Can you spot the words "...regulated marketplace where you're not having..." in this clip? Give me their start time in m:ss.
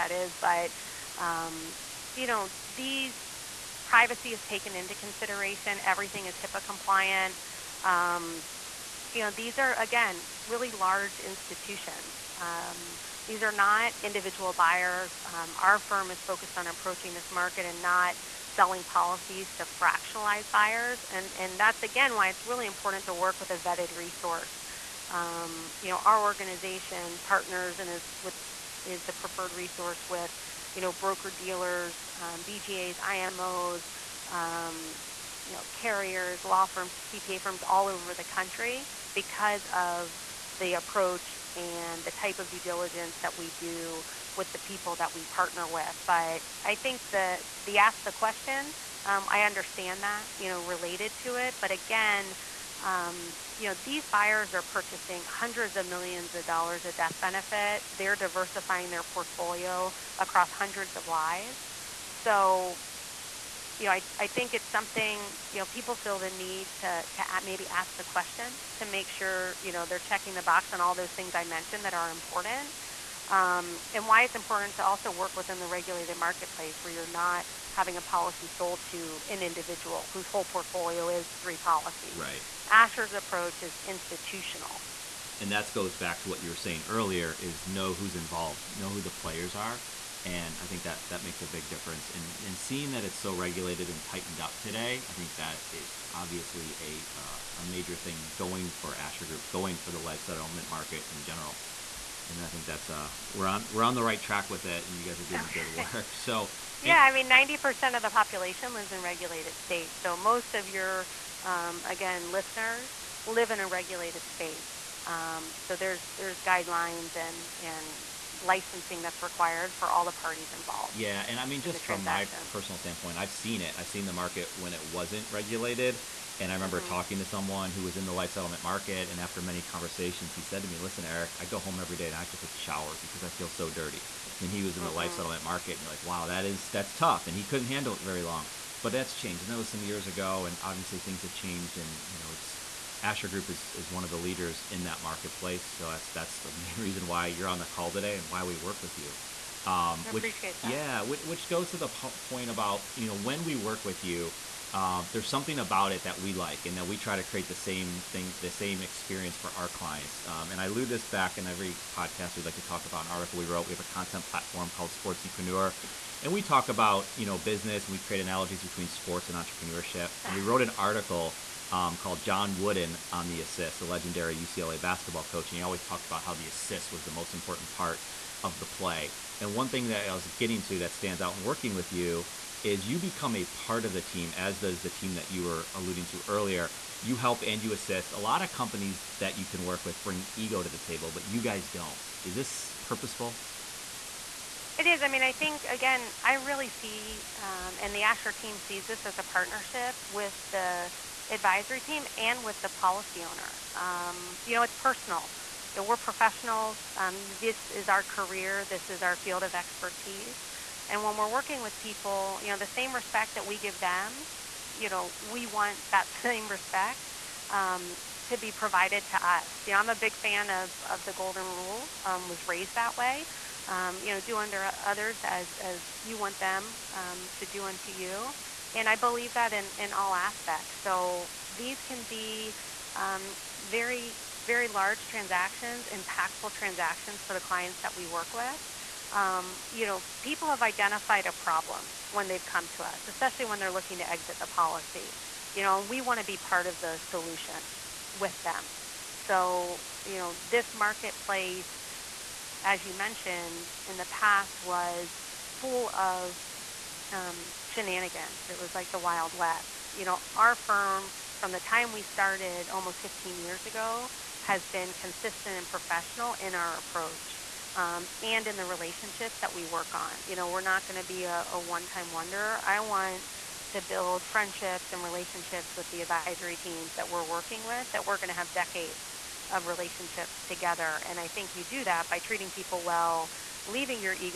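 1:15.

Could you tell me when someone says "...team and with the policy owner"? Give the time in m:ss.
3:21.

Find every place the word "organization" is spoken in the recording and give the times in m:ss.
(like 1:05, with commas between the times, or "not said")
0:26.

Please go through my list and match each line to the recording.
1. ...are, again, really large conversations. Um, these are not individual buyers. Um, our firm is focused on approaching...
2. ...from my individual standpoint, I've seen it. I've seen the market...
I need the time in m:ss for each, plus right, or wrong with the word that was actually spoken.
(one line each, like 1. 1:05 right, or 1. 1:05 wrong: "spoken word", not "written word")
1. 0:09 wrong: "institutions", not "conversations"
2. 2:01 wrong: "personal", not "individual".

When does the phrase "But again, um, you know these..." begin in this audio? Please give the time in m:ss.
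0:51.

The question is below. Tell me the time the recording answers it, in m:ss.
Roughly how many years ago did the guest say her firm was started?
4:23.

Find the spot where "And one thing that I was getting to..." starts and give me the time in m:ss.
2:59.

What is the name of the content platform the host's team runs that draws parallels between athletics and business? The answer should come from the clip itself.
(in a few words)
Sportspreneur.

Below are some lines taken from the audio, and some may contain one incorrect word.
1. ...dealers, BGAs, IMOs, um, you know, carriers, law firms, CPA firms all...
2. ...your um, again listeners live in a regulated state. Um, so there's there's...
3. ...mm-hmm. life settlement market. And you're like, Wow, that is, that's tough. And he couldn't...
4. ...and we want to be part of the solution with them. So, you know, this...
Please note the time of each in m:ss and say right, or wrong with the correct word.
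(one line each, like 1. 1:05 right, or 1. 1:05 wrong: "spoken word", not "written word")
1. 0:31 right
2. 1:50 right
3. 2:14 right
4. 4:05 right.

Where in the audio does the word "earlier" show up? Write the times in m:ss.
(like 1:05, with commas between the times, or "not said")
1:26, 3:06.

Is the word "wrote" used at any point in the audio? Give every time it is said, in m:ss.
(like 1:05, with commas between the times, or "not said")
2:43, 2:50.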